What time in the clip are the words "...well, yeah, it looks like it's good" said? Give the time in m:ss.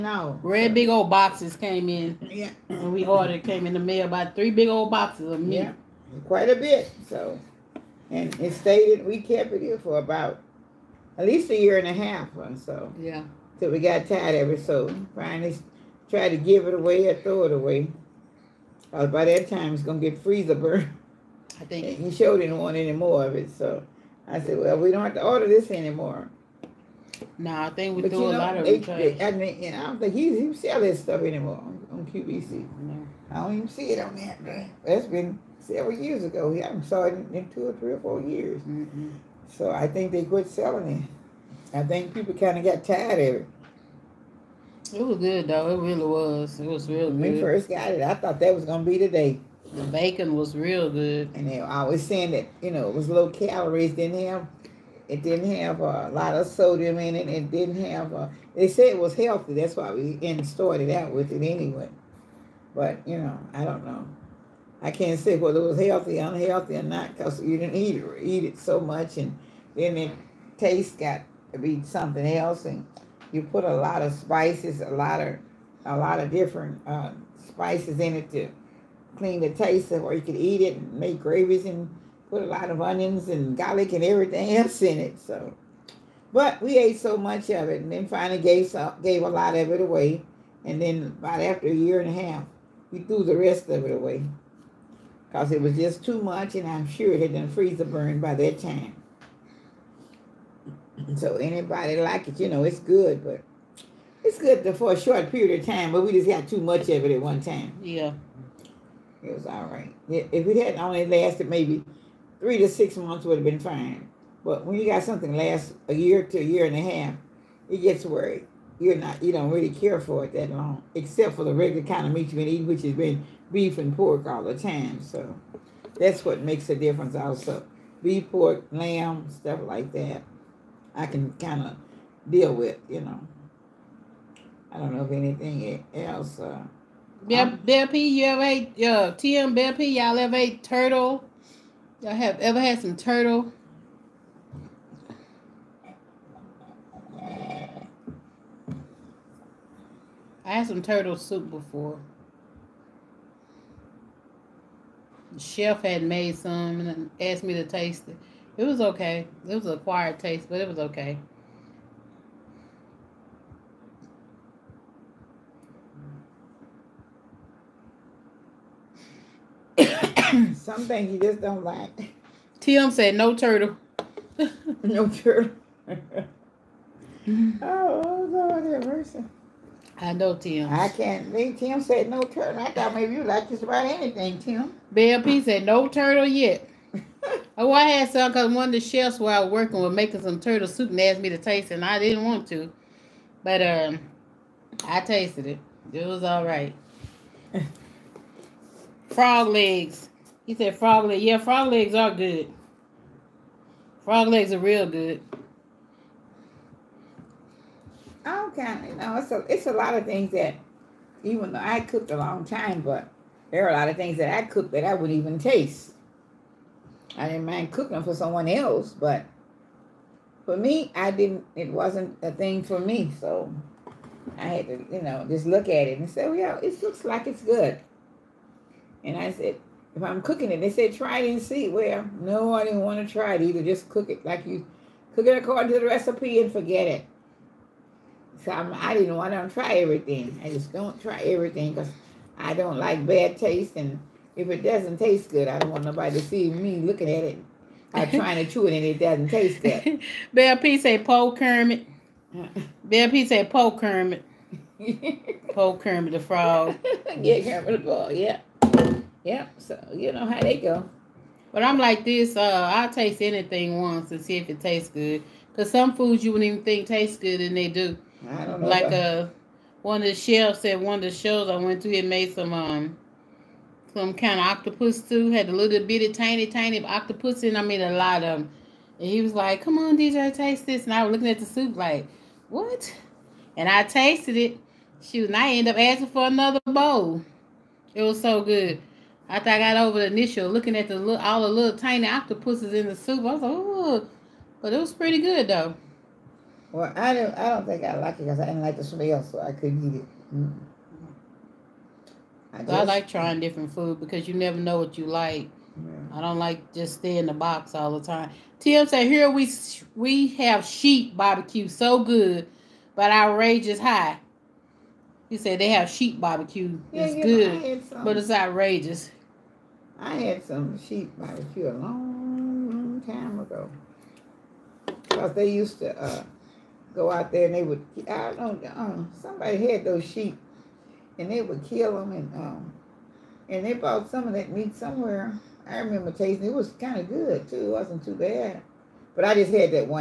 3:46.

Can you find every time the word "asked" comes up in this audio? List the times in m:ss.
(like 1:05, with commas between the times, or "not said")
2:37, 3:10.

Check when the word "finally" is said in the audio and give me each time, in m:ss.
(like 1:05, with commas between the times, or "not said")
0:15, 1:28.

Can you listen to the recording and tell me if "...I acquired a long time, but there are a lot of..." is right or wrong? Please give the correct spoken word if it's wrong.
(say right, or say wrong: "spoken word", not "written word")
wrong: "cooked", not "acquired".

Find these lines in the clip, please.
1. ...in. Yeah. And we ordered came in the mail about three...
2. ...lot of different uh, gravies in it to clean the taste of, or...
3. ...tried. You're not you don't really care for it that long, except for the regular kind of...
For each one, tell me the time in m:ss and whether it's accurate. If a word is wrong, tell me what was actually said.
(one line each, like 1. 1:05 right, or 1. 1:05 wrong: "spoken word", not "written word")
1. 0:01 right
2. 1:15 wrong: "spices", not "gravies"
3. 1:58 wrong: "worried", not "tried".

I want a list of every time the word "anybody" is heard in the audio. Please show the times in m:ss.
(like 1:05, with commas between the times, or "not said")
1:41.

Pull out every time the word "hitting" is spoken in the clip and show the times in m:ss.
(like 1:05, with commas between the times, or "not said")
not said.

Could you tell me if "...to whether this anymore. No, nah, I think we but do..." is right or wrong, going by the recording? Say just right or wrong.
wrong.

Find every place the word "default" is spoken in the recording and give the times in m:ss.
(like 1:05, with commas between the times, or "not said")
not said.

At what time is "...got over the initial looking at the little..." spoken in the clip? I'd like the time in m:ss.
4:49.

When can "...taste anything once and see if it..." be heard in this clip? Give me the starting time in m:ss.
4:22.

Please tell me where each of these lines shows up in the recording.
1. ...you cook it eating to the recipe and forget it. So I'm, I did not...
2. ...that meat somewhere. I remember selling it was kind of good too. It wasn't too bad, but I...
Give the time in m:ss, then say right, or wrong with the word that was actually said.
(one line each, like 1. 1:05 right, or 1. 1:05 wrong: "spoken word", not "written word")
1. 3:54 wrong: "according", not "eating"
2. 5:34 wrong: "tasting", not "selling".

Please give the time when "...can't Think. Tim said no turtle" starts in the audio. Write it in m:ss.
3:00.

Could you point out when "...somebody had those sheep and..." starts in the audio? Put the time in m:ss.
5:29.